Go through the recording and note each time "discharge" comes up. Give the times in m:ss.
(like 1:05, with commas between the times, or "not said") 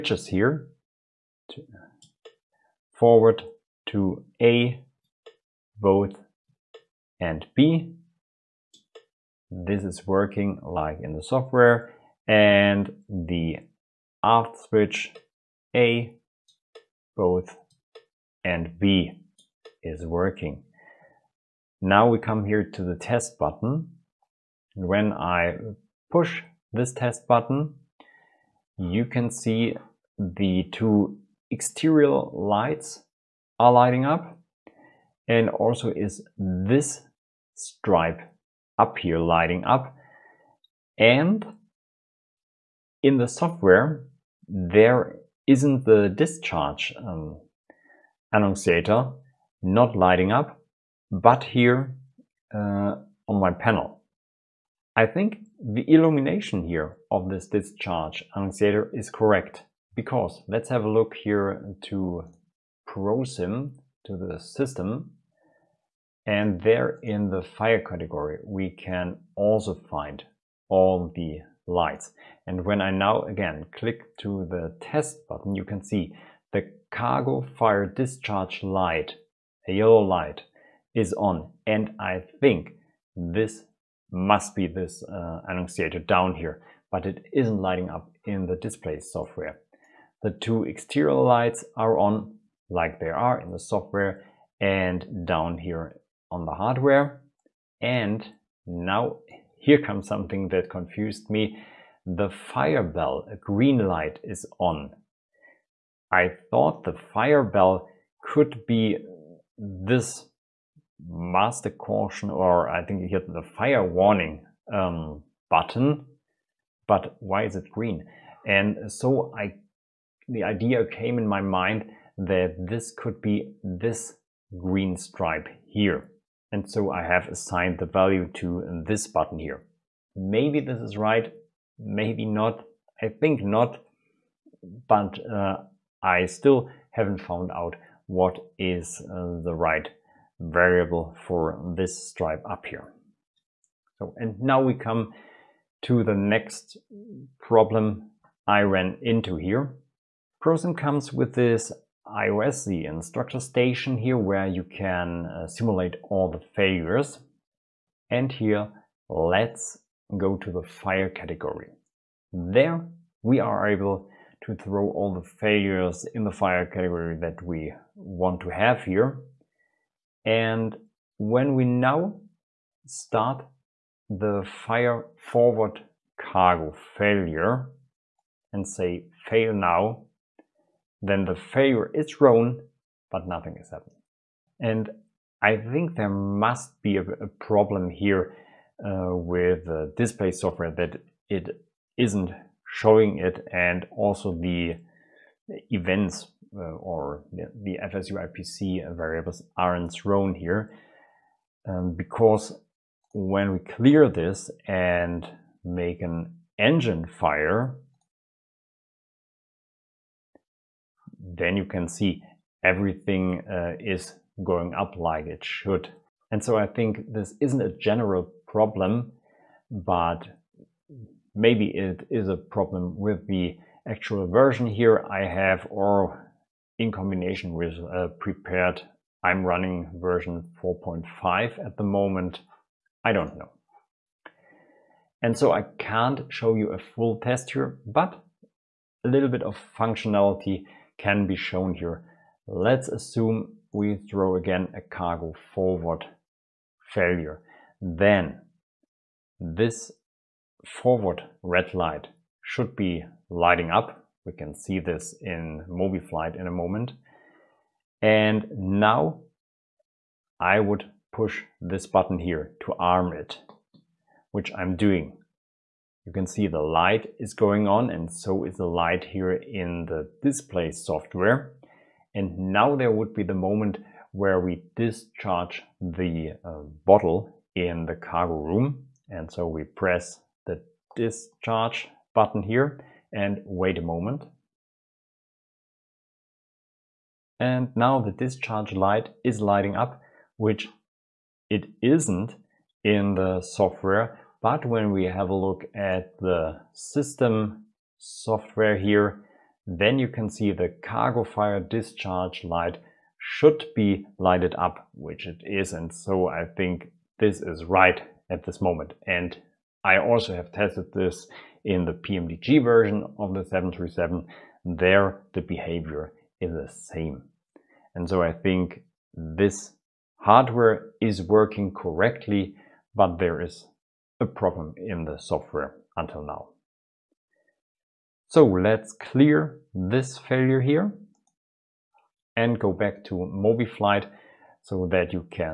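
0:46, 0:57, 1:17, 4:34, 4:40, 4:48, 5:01.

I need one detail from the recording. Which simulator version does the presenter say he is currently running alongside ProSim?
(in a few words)
4.5.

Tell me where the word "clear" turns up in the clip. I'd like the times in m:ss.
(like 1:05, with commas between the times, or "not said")
3:23, 5:28.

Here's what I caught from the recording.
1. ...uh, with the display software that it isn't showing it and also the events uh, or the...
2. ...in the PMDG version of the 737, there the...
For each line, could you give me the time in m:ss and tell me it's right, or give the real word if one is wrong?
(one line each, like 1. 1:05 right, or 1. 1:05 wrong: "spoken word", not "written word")
1. 3:08 right
2. 5:11 right.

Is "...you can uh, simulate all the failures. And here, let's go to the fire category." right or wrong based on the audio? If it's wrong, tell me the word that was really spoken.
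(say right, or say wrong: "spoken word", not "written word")
right.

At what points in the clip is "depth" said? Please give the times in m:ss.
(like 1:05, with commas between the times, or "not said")
not said.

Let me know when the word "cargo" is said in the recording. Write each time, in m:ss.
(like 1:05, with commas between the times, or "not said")
1:16, 2:56, 4:04, 4:37, 5:00.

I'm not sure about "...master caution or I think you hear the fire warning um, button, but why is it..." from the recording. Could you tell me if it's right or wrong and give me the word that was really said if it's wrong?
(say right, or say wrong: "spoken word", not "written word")
right.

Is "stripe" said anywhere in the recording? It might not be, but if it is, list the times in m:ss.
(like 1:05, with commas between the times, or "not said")
0:37, 2:04, 2:22.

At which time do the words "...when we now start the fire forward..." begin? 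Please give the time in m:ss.
2:51.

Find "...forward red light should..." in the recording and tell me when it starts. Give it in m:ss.
4:10.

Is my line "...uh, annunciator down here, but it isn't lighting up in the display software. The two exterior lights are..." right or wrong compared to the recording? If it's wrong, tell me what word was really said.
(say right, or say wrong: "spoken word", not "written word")
right.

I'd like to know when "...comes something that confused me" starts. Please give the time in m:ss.
1:39.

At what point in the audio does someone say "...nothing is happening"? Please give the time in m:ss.
3:03.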